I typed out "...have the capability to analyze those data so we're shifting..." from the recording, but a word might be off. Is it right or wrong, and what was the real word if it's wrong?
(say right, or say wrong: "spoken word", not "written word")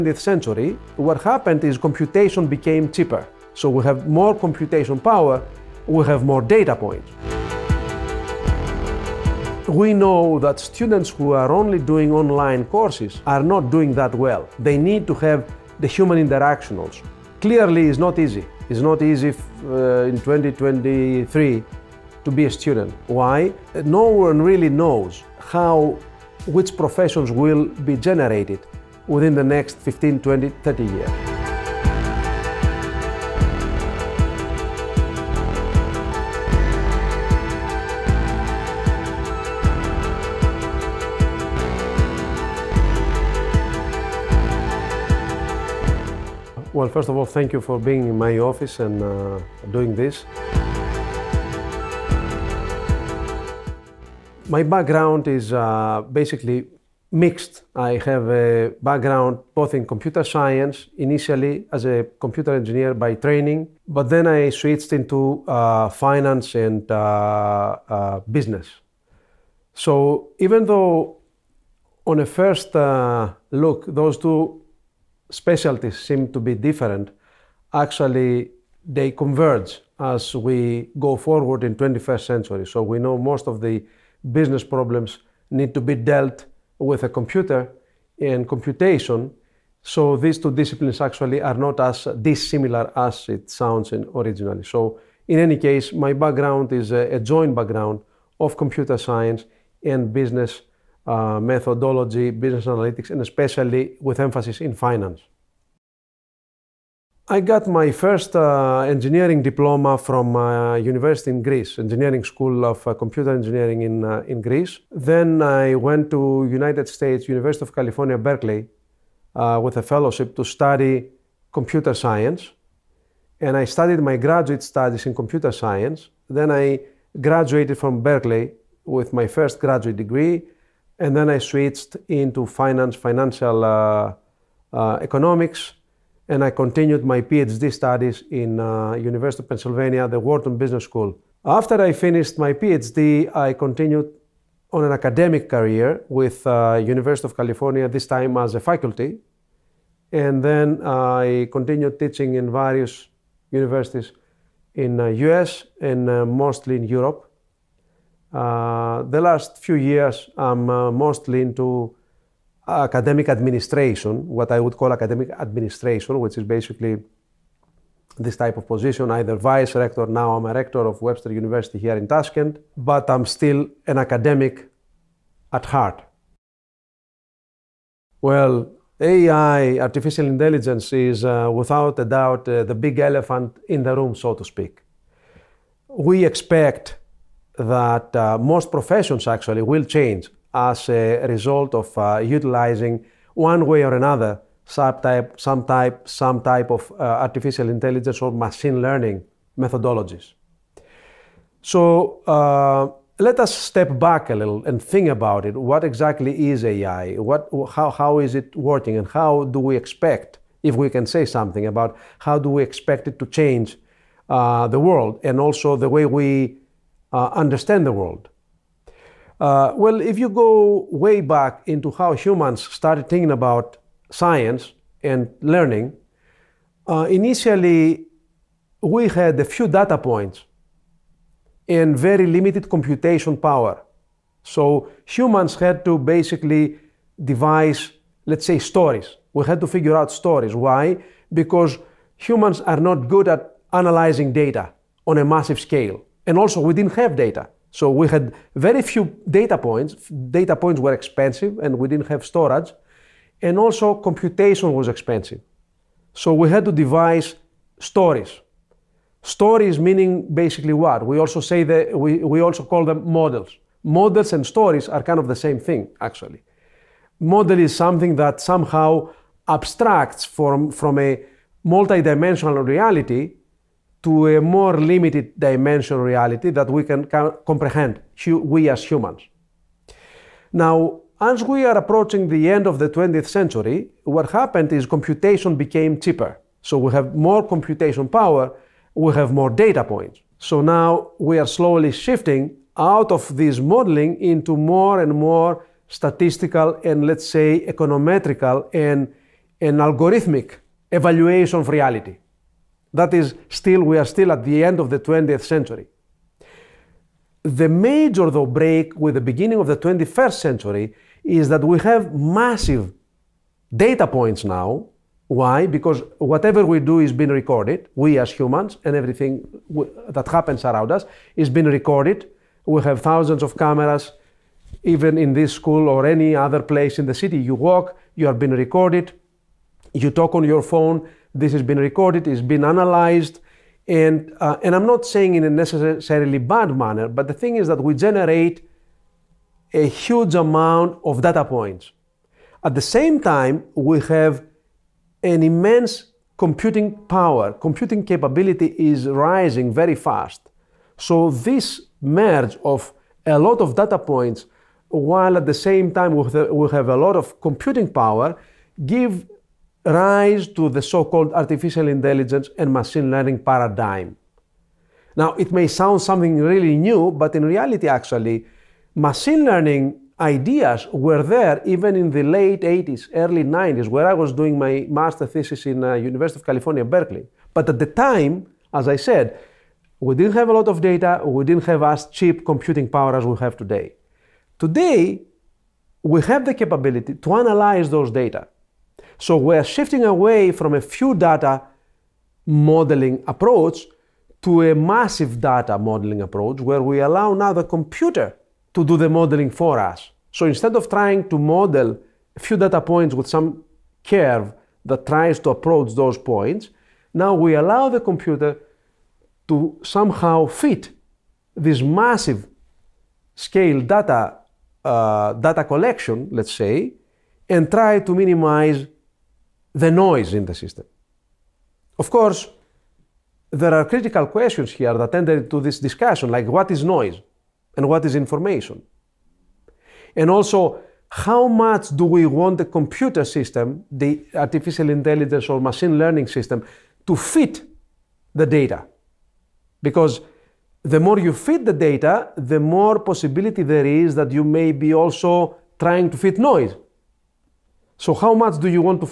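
right.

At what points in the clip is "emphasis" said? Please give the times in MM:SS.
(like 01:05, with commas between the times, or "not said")
01:44.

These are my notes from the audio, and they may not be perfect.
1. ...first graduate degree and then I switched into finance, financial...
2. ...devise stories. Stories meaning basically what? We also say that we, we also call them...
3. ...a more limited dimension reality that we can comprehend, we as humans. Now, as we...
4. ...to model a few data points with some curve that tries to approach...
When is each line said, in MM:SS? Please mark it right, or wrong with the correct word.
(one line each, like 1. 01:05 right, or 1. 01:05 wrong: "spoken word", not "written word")
1. 02:09 right
2. 04:16 right
3. 04:34 right
4. 06:41 right.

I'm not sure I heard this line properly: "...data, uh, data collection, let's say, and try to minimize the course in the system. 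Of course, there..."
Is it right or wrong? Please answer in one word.
wrong.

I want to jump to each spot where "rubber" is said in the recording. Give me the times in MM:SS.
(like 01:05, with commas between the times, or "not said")
not said.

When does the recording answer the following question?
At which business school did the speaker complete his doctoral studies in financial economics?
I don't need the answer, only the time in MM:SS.
02:20.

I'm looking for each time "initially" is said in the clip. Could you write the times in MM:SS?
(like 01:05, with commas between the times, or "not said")
01:00, 03:47.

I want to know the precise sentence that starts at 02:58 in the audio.
Well, AI, artificial intelligence, is uh, without a doubt uh, the big elephant in the room, so to speak.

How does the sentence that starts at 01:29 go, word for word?
So these two disciplines actually are not as dissimilar as it sounds originally.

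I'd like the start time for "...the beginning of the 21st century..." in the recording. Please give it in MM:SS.
05:09.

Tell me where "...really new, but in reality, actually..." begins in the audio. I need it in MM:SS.
06:06.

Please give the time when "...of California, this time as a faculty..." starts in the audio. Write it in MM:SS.
02:27.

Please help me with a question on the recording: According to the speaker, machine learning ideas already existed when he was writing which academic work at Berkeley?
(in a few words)
master thesis.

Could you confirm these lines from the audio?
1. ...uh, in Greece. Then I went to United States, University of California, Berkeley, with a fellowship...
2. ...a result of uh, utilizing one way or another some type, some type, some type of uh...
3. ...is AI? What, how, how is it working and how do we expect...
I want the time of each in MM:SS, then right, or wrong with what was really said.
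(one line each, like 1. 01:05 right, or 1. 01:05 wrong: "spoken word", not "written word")
1. 01:54 right
2. 03:10 right
3. 03:26 right.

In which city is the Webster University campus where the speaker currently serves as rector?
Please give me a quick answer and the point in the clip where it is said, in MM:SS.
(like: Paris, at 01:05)
Tashkent, at 02:52.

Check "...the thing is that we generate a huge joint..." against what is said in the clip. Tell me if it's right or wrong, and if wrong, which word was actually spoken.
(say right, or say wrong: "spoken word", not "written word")
wrong: "amount", not "joint".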